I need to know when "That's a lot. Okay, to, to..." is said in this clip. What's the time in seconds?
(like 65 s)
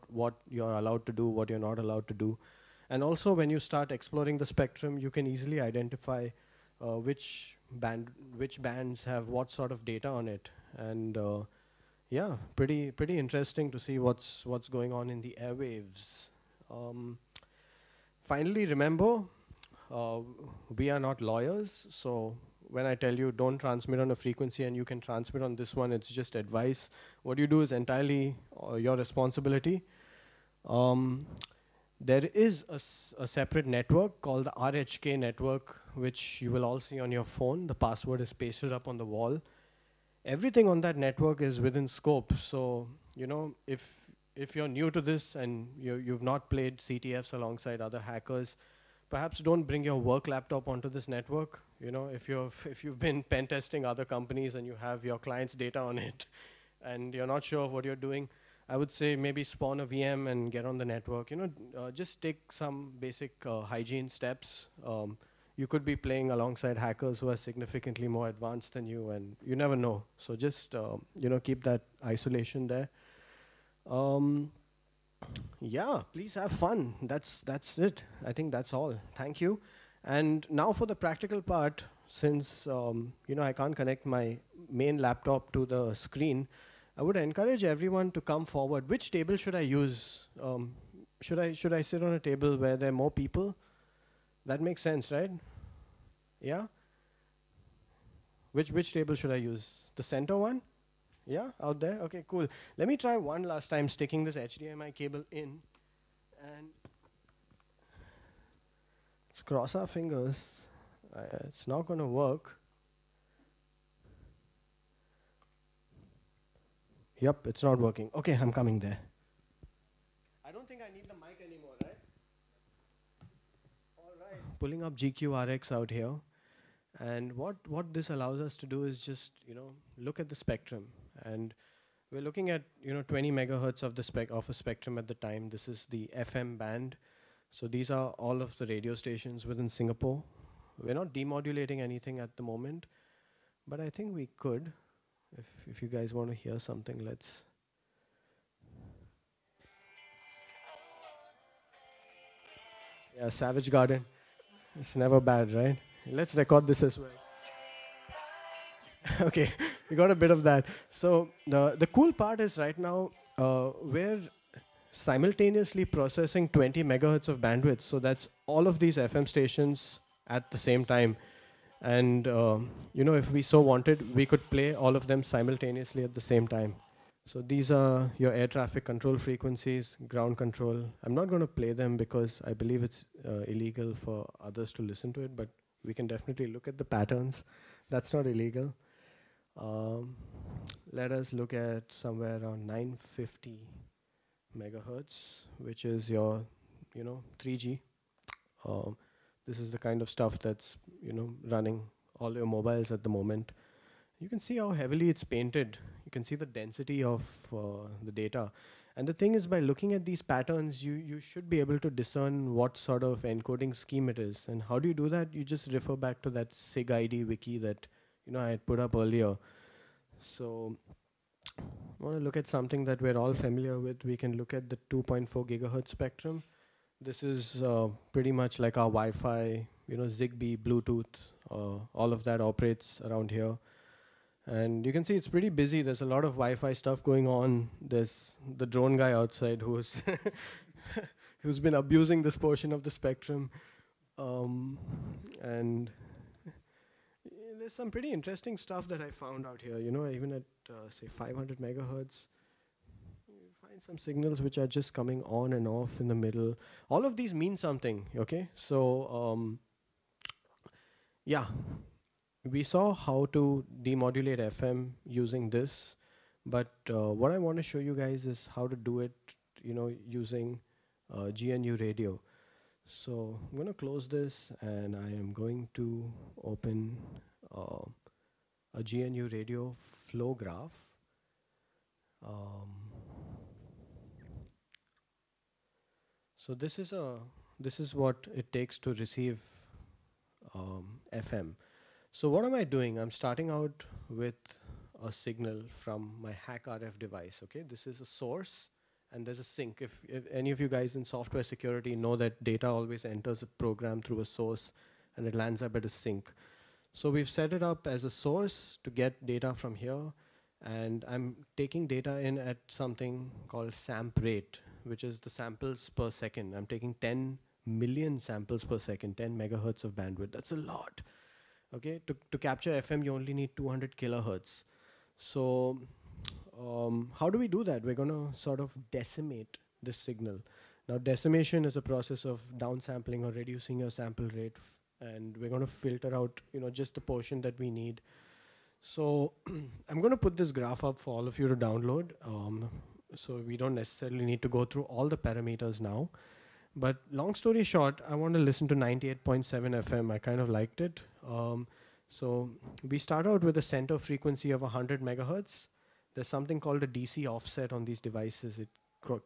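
320 s.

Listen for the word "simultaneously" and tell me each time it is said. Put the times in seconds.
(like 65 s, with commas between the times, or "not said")
164 s, 175 s.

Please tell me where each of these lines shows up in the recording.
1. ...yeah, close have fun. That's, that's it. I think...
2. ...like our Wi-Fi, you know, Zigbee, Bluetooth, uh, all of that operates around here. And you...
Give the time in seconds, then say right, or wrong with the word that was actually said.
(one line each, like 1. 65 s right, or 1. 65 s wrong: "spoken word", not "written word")
1. 75 s wrong: "please", not "close"
2. 228 s right.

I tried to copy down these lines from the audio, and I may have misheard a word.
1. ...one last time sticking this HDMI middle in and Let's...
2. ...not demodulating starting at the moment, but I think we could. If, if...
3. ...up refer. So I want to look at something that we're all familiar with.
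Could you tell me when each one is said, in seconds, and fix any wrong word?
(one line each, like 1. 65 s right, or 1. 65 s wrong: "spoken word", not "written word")
1. 103 s wrong: "cable", not "middle"
2. 140 s wrong: "anything", not "starting"
3. 218 s wrong: "earlier", not "refer".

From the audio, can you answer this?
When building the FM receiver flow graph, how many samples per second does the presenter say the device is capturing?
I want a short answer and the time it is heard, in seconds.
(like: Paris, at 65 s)
10 million, at 316 s.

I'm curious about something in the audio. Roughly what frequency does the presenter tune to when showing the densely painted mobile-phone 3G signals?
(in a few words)
950 megahertz.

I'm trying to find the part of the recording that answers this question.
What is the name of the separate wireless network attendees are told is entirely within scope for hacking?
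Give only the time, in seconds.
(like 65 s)
34 s.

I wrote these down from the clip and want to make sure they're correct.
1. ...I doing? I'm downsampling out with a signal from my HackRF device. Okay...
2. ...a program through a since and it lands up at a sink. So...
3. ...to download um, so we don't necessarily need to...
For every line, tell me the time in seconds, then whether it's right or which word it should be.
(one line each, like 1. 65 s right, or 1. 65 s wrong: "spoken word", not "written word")
1. 292 s wrong: "starting", not "downsampling"
2. 303 s wrong: "source", not "since"
3. 341 s right.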